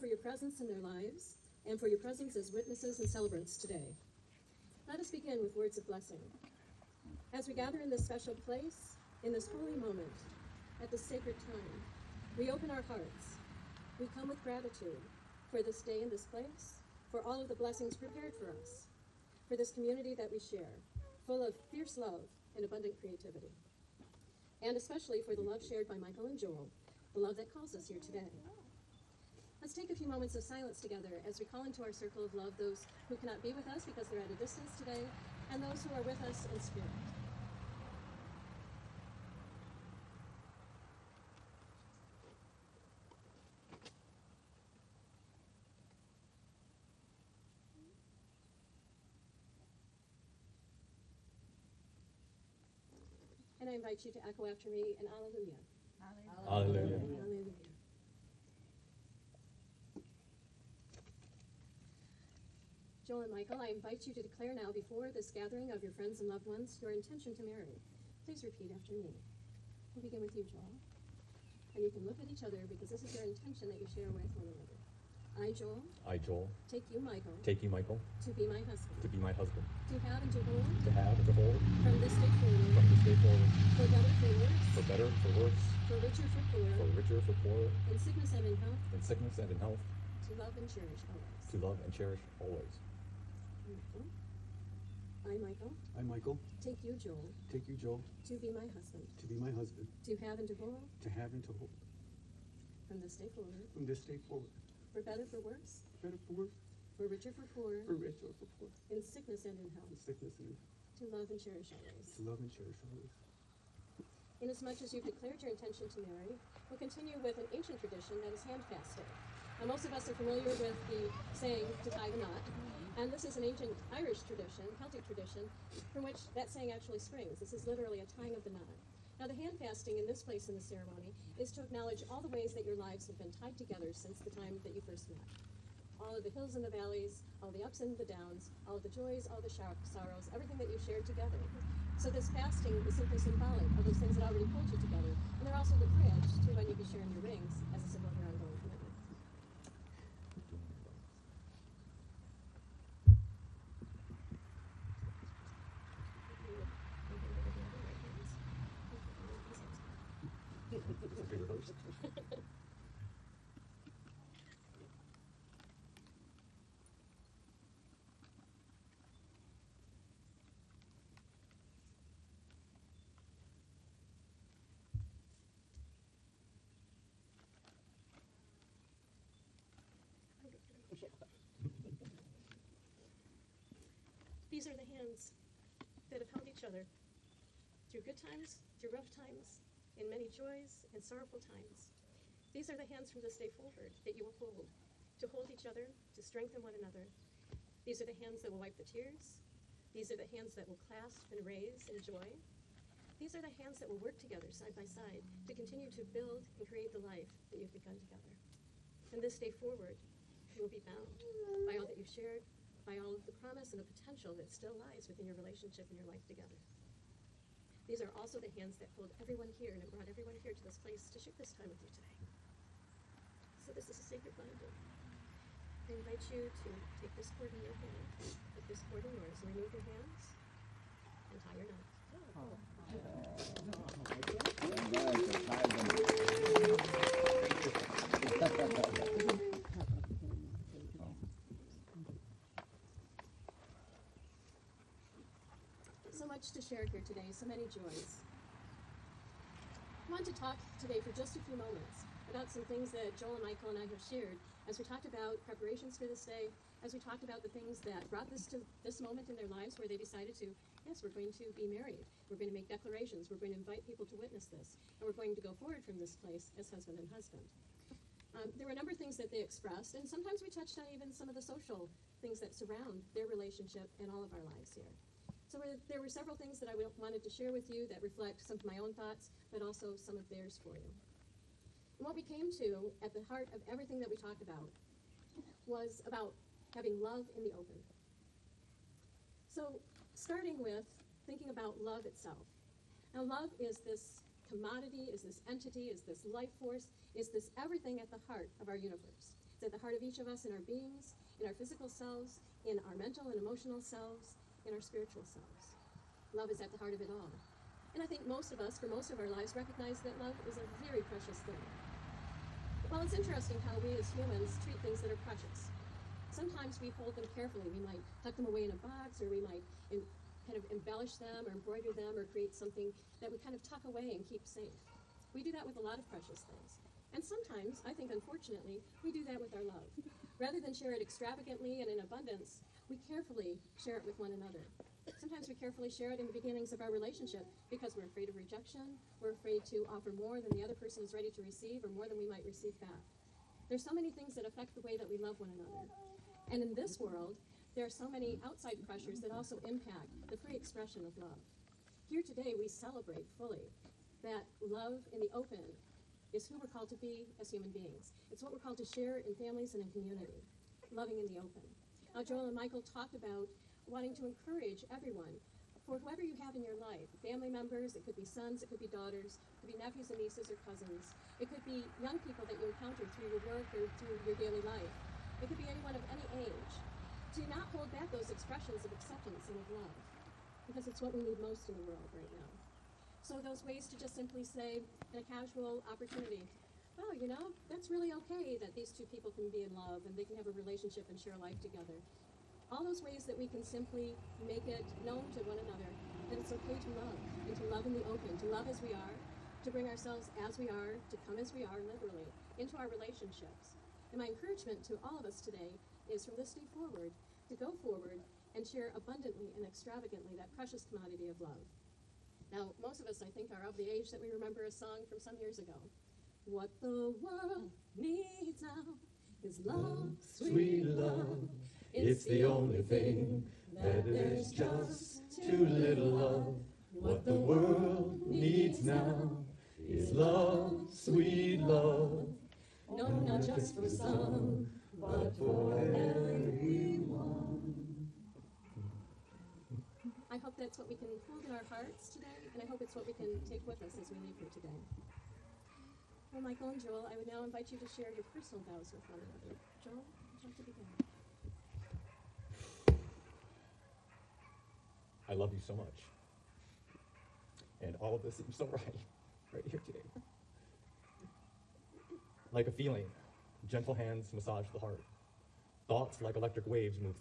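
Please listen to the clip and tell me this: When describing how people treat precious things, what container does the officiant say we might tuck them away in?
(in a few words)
A box.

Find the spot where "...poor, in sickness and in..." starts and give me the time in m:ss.
1:48.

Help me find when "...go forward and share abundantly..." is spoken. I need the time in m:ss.
6:47.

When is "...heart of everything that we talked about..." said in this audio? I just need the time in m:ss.
4:43.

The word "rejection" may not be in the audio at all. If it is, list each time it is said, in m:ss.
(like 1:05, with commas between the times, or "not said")
5:38.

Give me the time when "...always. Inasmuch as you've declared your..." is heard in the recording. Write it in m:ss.
1:52.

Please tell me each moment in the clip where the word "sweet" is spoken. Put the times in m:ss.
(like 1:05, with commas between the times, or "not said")
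7:00, 7:10.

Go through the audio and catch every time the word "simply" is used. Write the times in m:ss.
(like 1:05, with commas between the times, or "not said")
2:22, 6:24, 6:33.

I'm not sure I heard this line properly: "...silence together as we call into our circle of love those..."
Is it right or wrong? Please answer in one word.
right.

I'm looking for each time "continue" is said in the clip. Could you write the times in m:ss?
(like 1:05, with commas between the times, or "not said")
1:56, 3:25.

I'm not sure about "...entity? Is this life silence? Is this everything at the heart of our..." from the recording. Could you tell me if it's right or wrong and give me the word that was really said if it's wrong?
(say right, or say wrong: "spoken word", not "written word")
wrong: "force", not "silence".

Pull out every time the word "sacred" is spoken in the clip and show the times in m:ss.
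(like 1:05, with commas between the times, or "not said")
0:11, 3:44.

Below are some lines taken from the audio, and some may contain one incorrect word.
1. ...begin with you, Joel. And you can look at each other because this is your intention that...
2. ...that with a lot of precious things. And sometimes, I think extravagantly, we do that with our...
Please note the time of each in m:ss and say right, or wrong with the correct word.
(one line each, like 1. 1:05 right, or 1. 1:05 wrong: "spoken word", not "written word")
1. 1:10 right
2. 5:25 wrong: "unfortunately", not "extravagantly".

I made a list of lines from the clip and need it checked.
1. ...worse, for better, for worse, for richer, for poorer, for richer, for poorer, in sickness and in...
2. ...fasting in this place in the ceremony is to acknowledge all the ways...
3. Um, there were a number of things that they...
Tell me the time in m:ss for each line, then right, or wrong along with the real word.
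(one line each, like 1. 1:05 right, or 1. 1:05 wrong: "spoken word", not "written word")
1. 1:24 right
2. 2:09 right
3. 4:28 right.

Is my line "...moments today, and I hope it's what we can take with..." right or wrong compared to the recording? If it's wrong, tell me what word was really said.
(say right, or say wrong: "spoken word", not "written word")
wrong: "hearts", not "moments".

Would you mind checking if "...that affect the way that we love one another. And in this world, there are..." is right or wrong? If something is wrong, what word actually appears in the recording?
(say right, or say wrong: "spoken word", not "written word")
right.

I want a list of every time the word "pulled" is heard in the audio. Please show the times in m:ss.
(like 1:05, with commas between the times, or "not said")
2:24, 3:38.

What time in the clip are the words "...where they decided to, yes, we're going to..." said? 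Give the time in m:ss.
4:19.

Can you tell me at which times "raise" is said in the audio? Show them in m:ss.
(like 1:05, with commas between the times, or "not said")
3:21.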